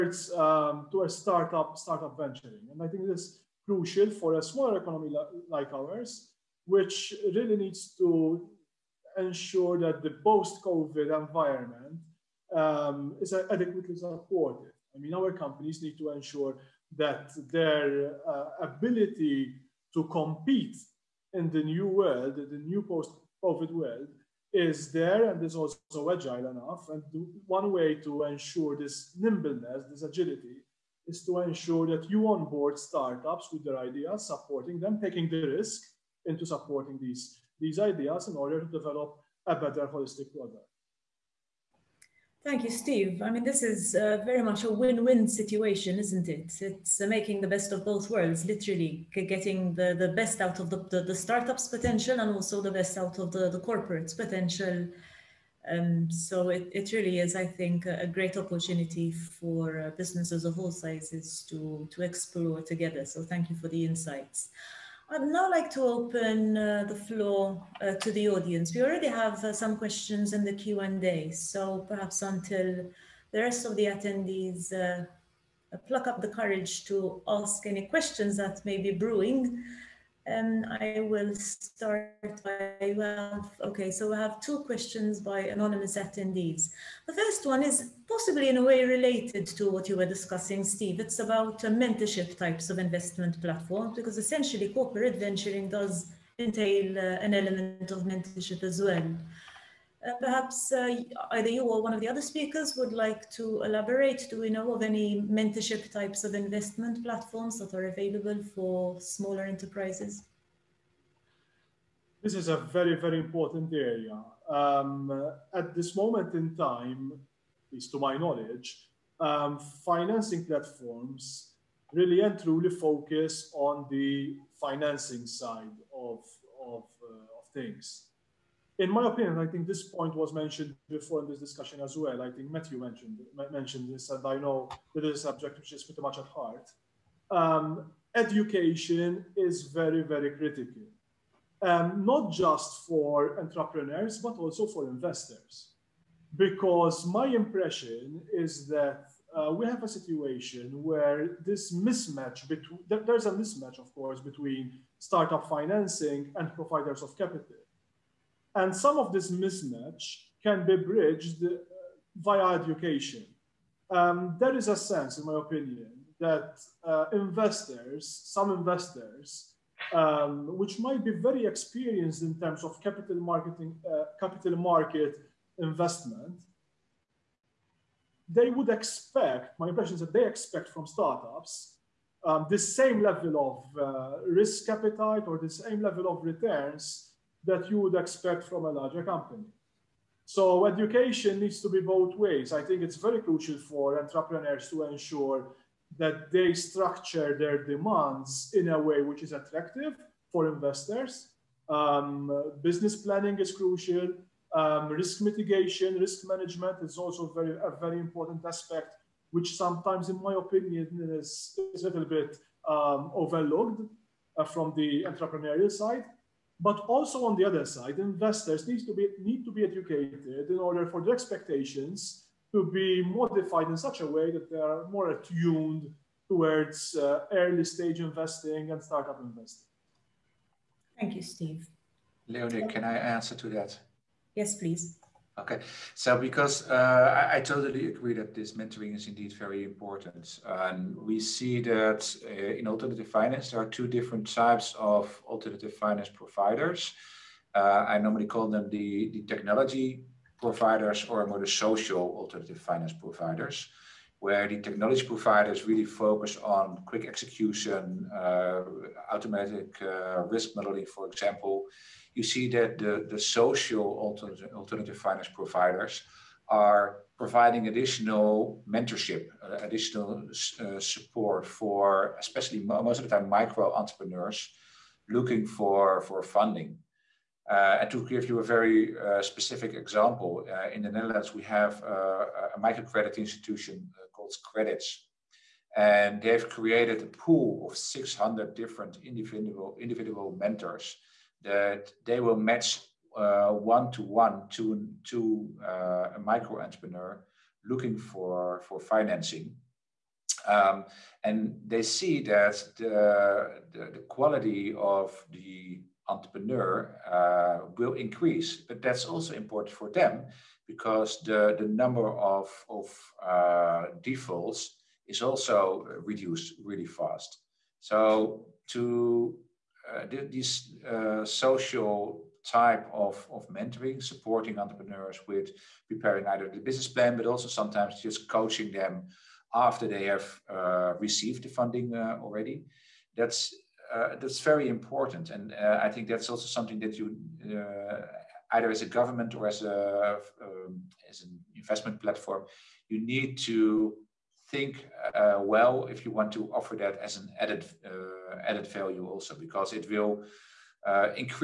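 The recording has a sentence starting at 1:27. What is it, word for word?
The first one is possibly in a way related to what you were discussing, Steve.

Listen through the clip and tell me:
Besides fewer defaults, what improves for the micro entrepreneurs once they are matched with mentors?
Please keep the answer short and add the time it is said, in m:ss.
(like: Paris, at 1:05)
Quality of the entrepreneur, at 5:04.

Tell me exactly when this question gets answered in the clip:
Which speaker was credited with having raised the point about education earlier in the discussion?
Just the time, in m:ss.
2:12.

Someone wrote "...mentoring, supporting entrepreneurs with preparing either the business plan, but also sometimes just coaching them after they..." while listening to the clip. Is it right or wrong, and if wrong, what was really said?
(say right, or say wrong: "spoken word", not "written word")
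right.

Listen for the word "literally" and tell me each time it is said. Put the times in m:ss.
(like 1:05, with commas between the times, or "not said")
0:48.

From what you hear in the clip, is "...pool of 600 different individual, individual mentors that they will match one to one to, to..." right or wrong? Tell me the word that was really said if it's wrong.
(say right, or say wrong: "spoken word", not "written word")
right.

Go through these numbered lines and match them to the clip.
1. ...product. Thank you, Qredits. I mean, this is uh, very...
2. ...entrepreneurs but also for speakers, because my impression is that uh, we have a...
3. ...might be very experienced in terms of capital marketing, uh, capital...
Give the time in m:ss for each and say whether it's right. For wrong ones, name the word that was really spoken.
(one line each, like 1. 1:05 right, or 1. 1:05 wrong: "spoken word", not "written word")
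1. 0:40 wrong: "Steve", not "Qredits"
2. 2:23 wrong: "investors", not "speakers"
3. 2:50 right.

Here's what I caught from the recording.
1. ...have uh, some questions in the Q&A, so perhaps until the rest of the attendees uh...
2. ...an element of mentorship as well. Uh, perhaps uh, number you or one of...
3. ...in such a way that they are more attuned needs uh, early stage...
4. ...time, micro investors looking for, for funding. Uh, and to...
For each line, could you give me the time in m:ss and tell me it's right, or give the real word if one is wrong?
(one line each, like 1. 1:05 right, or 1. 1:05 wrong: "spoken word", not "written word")
1. 1:09 right
2. 1:37 wrong: "either", not "number"
3. 3:43 wrong: "towards", not "needs"
4. 4:33 wrong: "entrepreneurs", not "investors".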